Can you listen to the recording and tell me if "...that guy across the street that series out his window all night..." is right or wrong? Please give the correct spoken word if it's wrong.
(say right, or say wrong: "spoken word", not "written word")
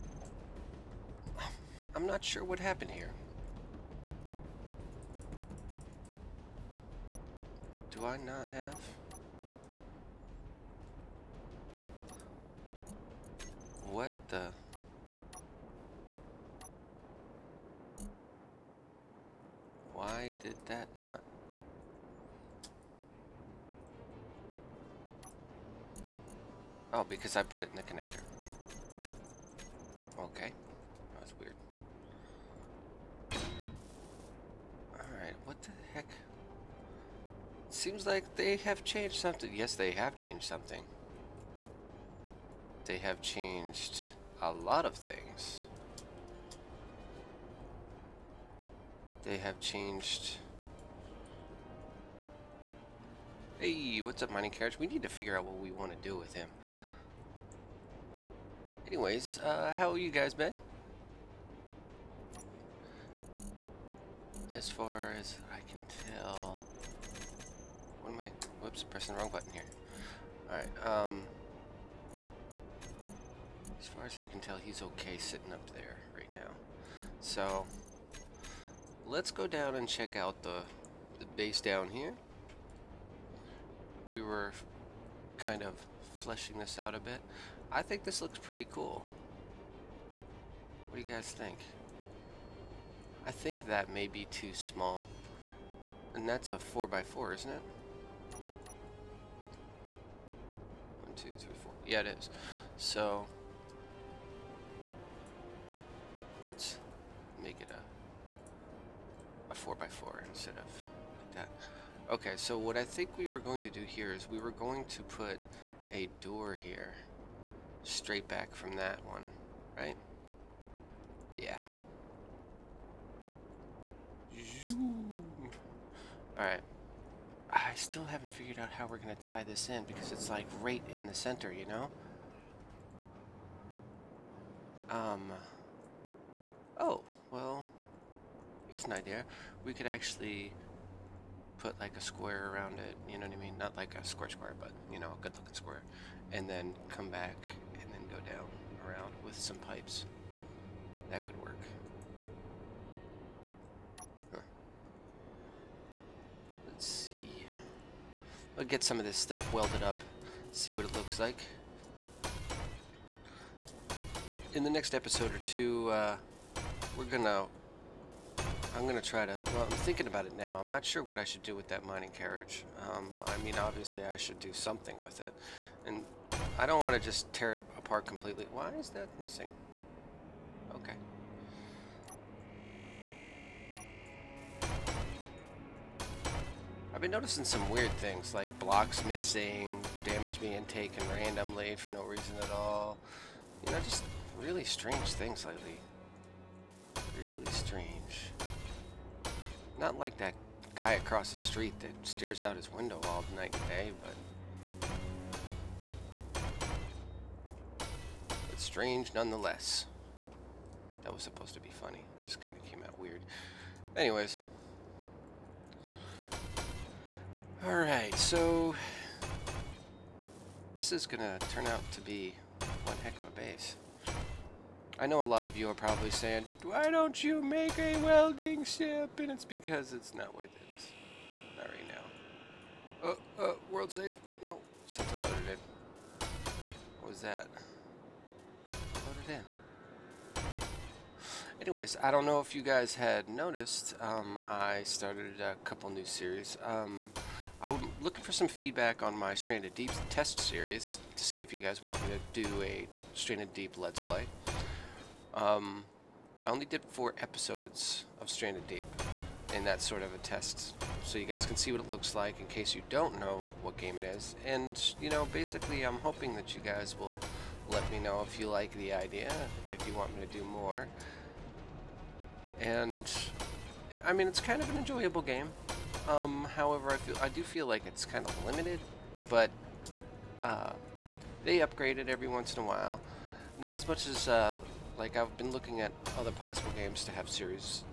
wrong: "stares", not "series".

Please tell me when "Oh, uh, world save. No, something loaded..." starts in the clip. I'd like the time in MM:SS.
03:53.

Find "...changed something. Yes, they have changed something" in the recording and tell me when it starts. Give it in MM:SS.
00:38.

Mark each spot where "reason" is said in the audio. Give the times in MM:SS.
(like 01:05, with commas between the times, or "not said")
03:12.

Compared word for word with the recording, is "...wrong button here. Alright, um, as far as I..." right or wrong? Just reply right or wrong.
right.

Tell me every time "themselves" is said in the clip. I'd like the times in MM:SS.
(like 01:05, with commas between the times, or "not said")
not said.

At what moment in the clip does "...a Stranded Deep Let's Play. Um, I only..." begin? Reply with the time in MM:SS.
04:12.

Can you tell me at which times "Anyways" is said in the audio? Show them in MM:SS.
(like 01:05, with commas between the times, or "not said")
00:58, 03:33, 04:01.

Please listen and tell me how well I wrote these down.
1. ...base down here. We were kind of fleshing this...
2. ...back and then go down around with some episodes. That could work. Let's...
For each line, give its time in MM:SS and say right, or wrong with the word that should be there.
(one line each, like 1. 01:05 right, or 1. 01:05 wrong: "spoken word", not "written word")
1. 01:21 right
2. 02:27 wrong: "pipes", not "episodes".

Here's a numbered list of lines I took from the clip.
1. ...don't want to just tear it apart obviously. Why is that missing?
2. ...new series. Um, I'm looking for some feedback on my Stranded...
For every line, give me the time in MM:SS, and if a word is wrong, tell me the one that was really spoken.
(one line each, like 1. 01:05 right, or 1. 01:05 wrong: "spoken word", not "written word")
1. 02:56 wrong: "completely", not "obviously"
2. 04:05 right.